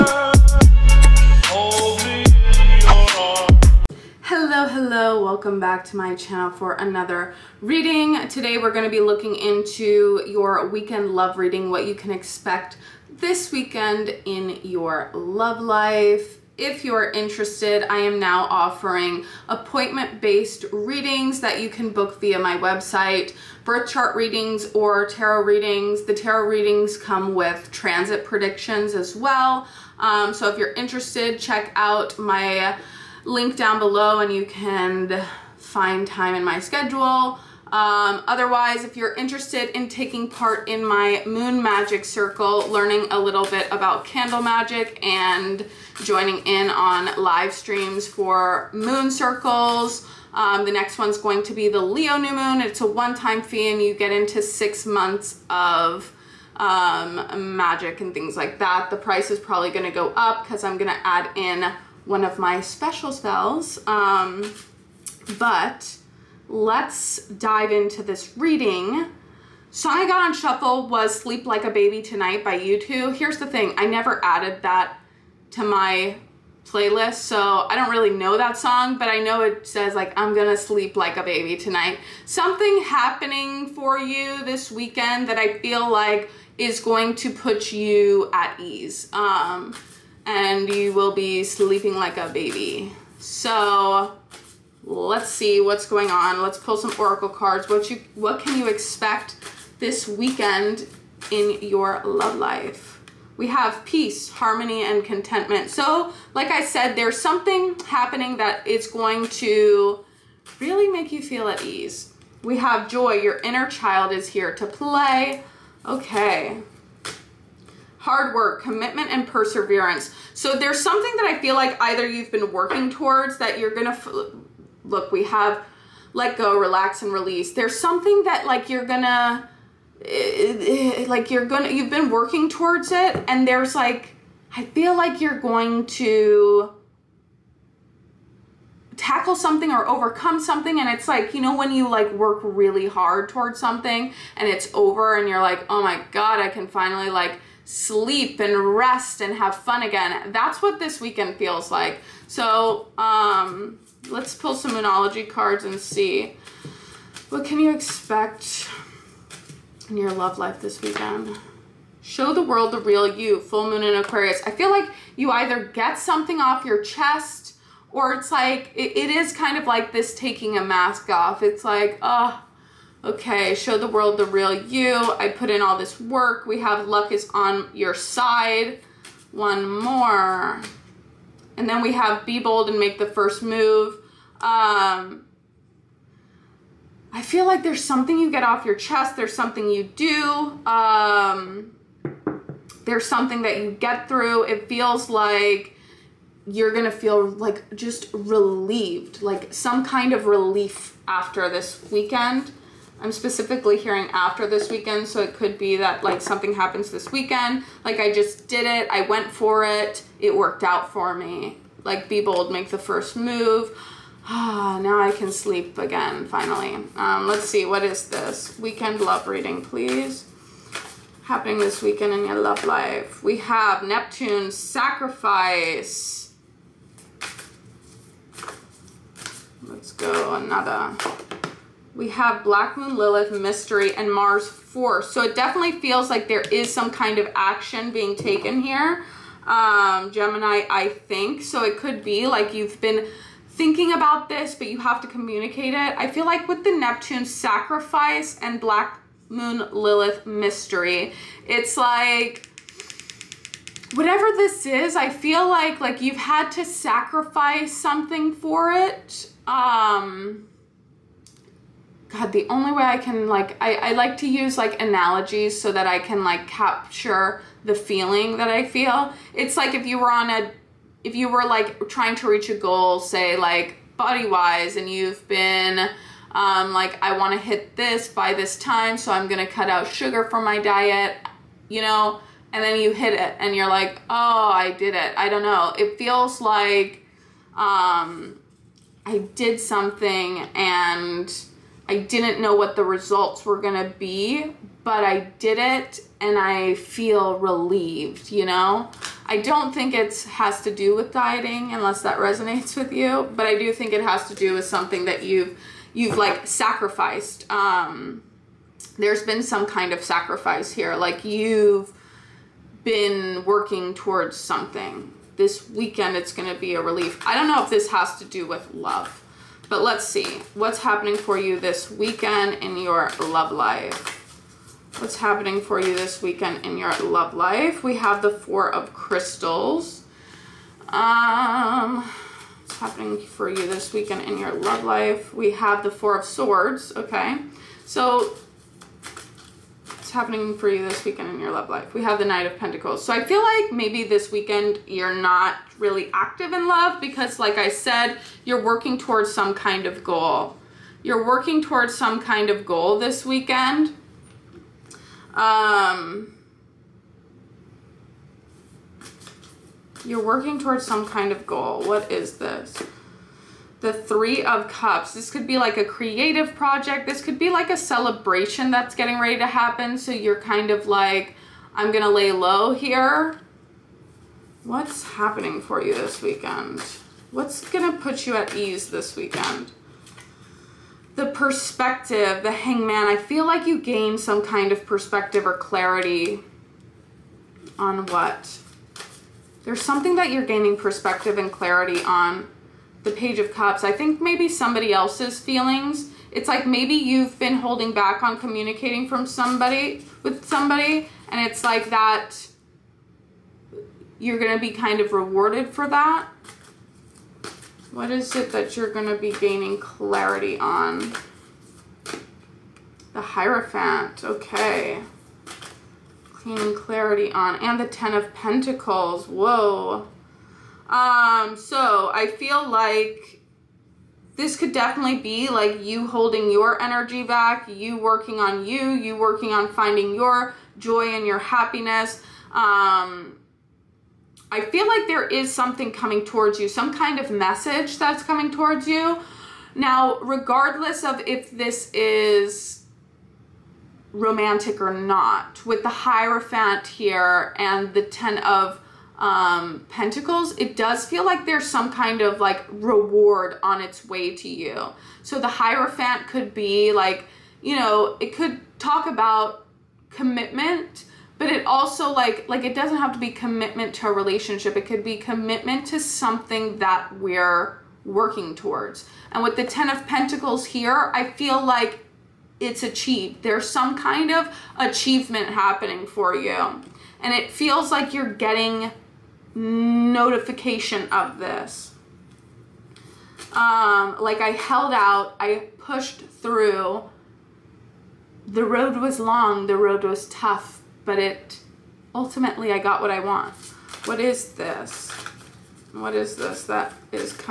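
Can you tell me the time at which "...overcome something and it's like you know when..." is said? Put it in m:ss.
2:19.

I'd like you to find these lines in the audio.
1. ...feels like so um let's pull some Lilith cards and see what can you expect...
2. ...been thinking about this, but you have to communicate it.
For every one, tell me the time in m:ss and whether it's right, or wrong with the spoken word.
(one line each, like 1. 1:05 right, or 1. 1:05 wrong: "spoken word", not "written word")
1. 2:31 wrong: "Moonology", not "Lilith"
2. 4:02 right.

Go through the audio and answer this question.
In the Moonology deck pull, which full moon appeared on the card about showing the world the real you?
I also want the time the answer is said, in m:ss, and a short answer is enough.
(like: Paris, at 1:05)
Full moon in Aquarius, at 2:43.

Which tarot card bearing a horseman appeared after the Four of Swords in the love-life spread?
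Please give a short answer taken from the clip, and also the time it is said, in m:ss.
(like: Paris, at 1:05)
Knight of Pentacles, at 5:42.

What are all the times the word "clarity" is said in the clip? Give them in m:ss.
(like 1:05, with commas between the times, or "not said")
6:25, 6:31, 6:49, 6:56.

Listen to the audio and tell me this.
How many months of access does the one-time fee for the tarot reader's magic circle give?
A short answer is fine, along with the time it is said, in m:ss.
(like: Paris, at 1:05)
6, at 0:54.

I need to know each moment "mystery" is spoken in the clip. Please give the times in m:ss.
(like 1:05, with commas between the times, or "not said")
3:53, 4:10.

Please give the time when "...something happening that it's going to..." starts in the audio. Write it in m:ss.
1:47.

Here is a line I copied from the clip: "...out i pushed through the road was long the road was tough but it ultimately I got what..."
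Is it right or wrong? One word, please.
right.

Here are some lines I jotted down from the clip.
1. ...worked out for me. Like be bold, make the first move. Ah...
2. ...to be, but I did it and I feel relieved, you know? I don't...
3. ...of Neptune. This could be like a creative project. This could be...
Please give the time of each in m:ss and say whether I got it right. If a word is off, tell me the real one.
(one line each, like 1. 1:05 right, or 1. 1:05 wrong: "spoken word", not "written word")
1. 3:30 right
2. 4:53 right
3. 6:04 wrong: "Cups", not "Neptune".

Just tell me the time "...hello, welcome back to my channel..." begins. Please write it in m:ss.
0:04.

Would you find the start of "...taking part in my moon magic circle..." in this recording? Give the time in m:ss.
0:39.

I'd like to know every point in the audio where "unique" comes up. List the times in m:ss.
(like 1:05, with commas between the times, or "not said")
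not said.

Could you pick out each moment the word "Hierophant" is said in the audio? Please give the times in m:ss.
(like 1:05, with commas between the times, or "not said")
6:53, 7:25, 7:35.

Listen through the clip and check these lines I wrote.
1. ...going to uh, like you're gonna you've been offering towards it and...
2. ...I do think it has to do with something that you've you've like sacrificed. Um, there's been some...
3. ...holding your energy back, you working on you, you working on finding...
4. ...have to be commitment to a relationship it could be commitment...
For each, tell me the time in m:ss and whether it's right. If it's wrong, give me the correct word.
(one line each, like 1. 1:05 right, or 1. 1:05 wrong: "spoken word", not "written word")
1. 2:08 wrong: "working", not "offering"
2. 5:03 right
3. 7:06 right
4. 7:42 right.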